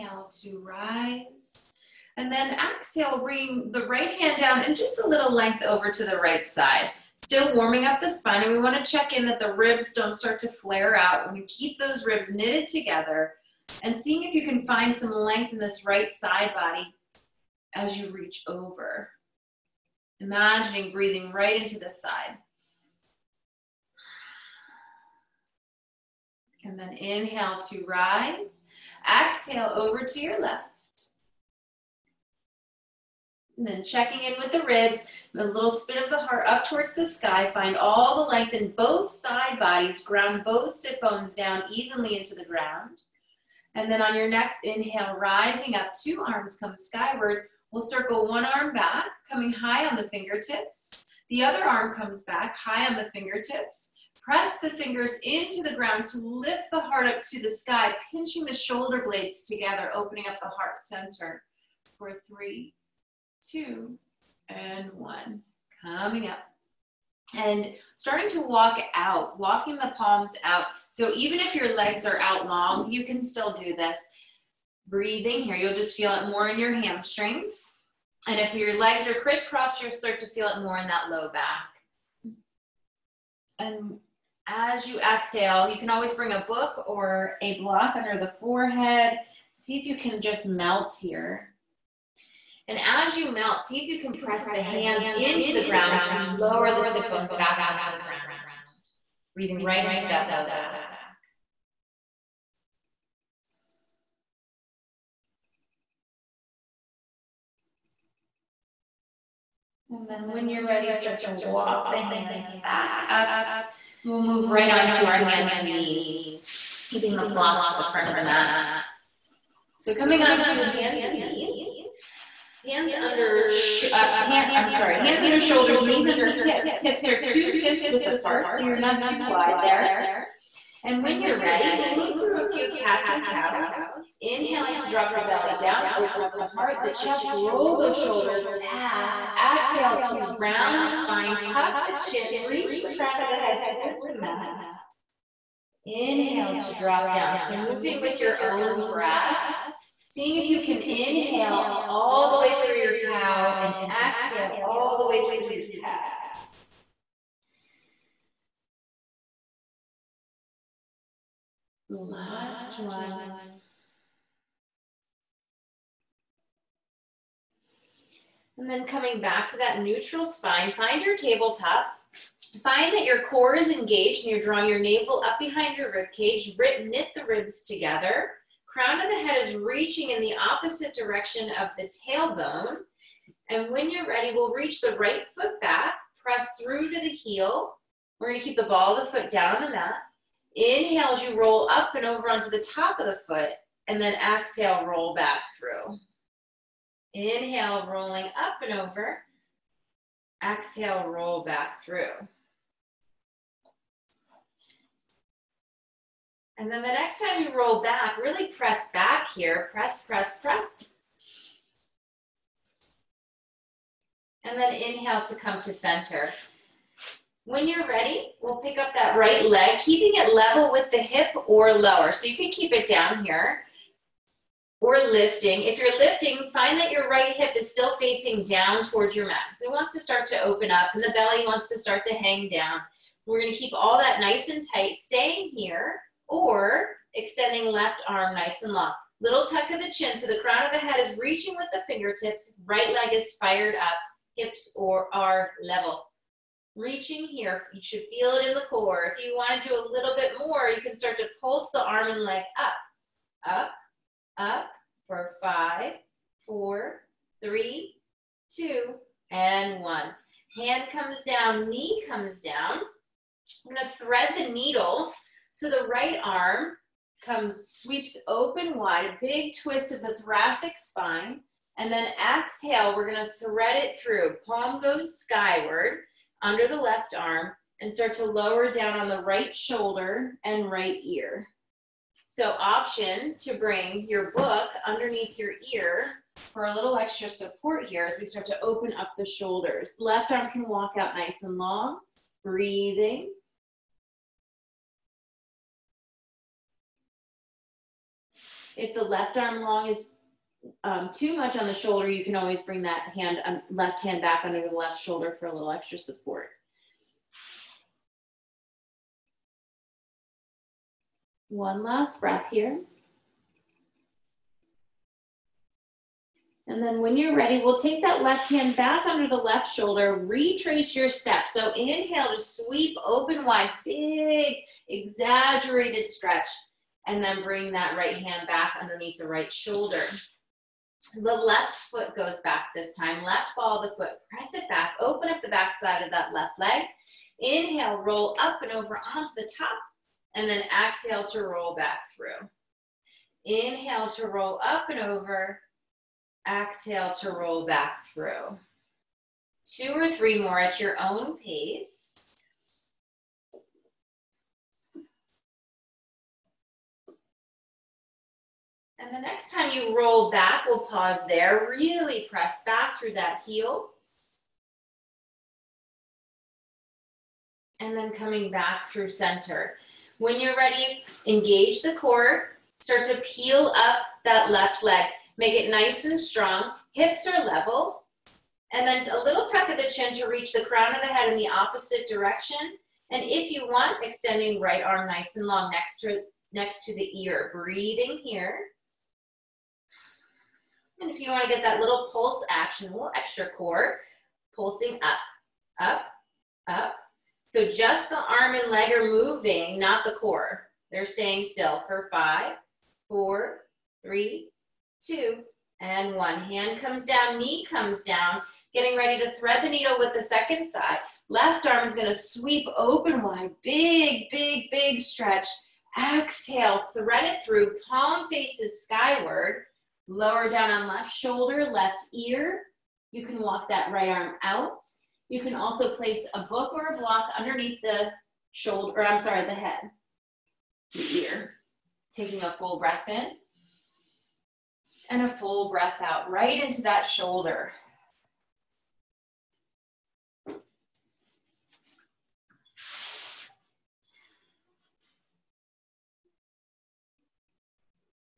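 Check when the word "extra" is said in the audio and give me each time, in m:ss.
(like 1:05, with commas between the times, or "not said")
4:46, 5:05, 6:33.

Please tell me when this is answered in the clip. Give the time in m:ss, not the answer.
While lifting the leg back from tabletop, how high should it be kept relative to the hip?
3:40.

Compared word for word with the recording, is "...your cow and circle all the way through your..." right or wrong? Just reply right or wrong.
wrong.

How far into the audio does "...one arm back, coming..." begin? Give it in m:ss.
0:48.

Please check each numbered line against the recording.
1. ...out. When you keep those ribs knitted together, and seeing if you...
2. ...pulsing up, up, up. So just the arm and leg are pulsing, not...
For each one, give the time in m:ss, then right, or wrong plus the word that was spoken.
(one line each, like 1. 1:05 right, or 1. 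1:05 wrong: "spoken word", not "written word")
1. 0:10 right
2. 6:34 wrong: "moving", not "pulsing".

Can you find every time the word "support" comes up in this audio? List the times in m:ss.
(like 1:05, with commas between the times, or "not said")
4:47, 5:05.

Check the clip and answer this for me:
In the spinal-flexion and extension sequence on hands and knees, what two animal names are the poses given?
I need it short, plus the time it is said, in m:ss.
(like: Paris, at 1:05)
cats and cows, at 2:12.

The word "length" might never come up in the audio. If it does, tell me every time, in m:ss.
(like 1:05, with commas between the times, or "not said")
0:05, 0:15, 0:38.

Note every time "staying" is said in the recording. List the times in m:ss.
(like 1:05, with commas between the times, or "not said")
3:54, 6:41.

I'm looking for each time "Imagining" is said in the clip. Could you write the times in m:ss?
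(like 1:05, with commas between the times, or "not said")
0:20.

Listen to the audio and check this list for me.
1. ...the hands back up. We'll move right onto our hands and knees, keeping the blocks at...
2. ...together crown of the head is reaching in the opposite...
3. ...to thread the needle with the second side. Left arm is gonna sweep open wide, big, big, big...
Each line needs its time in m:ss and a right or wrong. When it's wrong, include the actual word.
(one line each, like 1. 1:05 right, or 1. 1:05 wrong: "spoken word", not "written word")
1. 1:51 right
2. 2:57 right
3. 6:49 right.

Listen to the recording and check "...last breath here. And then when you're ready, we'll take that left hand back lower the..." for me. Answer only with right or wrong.
wrong.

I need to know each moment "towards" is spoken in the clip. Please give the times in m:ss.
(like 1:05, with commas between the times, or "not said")
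0:36, 2:23, 3:48.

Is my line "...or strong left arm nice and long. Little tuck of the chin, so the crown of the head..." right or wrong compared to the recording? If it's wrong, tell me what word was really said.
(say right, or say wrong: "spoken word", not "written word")
wrong: "extending", not "strong".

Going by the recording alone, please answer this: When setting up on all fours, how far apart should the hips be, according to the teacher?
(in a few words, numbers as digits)
two fists width.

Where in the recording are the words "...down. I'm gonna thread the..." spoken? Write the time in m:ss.
4:22.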